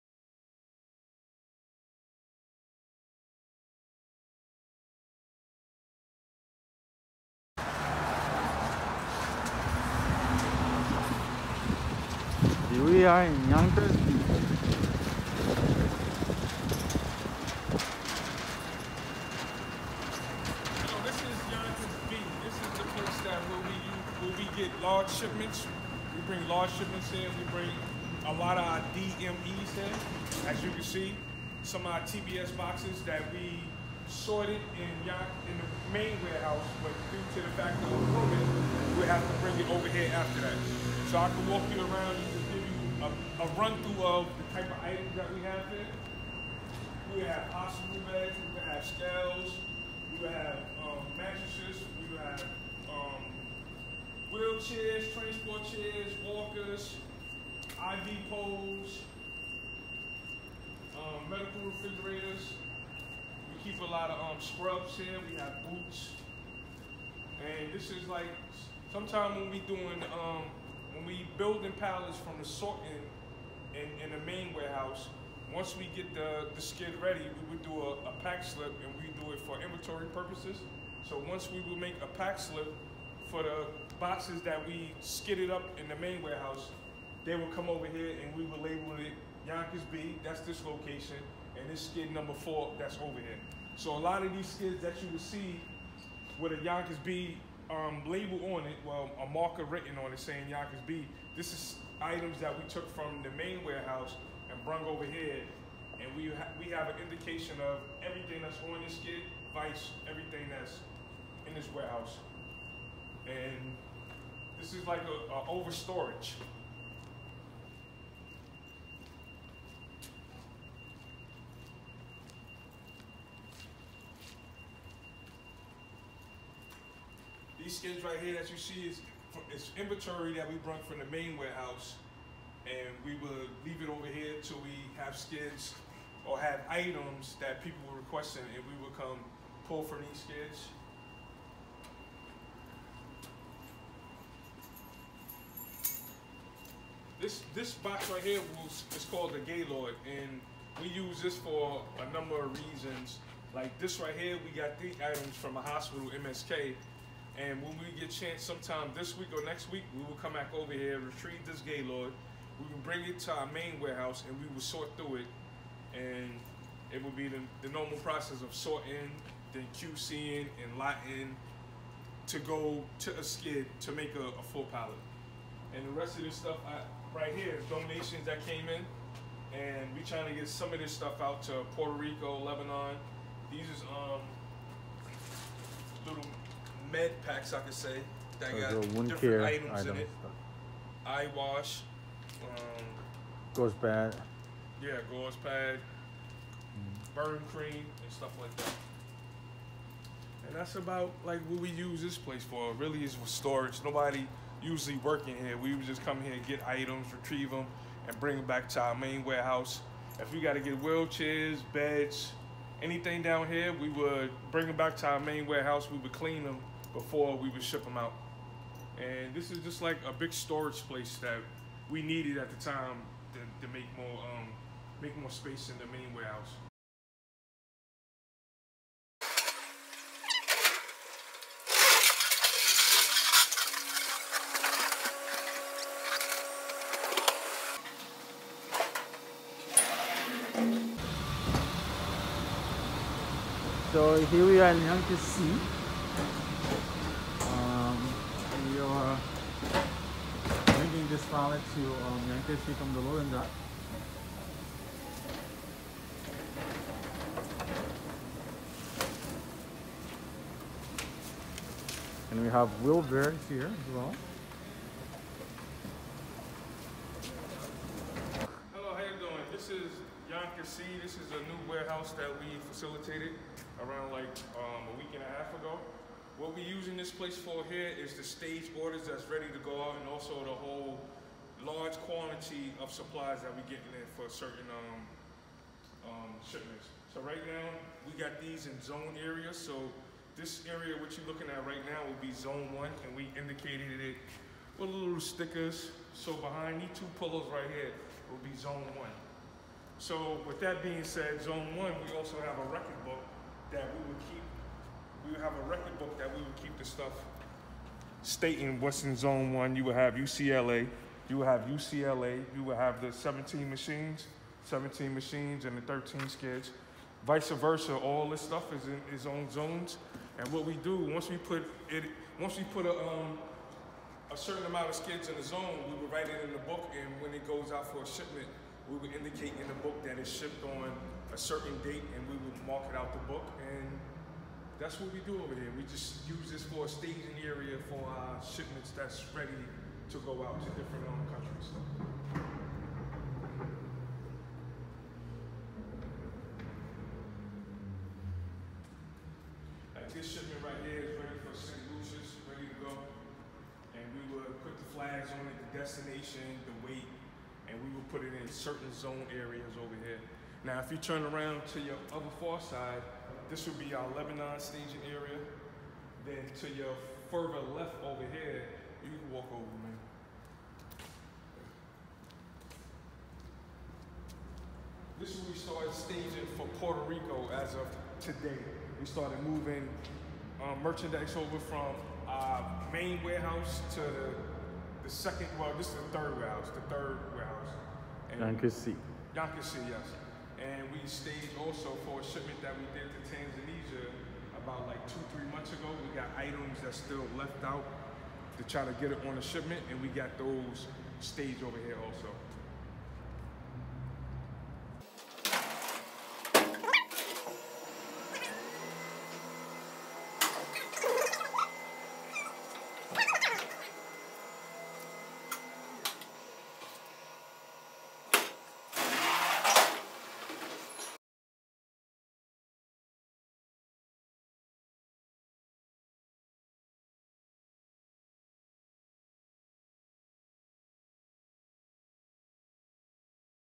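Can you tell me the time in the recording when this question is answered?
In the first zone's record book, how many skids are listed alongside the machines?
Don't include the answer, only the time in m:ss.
5:15.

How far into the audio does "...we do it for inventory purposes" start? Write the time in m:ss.
1:18.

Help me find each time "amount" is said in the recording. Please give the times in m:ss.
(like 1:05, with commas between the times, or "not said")
5:24.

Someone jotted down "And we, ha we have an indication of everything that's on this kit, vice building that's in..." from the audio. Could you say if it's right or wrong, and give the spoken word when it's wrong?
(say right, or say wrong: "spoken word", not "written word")
wrong: "everything", not "building".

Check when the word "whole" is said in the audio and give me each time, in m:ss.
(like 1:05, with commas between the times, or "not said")
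4:40.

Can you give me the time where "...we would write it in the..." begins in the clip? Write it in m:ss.
5:25.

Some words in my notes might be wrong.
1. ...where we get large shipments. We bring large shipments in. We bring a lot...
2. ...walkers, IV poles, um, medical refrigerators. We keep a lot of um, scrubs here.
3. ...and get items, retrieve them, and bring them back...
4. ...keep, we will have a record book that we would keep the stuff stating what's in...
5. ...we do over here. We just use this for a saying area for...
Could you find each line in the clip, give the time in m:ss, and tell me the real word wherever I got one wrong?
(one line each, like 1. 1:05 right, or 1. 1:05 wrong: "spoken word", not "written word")
1. 0:24 right
2. 0:56 right
3. 3:26 right
4. 5:04 right
5. 5:35 wrong: "staging", not "saying".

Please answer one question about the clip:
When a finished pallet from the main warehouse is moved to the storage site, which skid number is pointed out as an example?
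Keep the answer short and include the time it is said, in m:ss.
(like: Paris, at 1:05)
4, at 1:31.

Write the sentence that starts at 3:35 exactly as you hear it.
We would clean them before we would ship them out.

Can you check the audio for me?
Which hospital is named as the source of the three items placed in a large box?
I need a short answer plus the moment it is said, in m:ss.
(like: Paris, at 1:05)
MSK, at 2:36.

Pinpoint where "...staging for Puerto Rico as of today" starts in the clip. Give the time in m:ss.
6:15.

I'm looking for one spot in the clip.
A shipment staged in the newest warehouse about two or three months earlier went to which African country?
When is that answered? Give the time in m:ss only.
6:33.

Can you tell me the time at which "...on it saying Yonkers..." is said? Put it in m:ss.
1:40.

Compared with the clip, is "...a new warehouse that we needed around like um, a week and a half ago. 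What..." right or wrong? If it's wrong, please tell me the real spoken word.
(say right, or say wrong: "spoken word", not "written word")
wrong: "facilitated", not "needed".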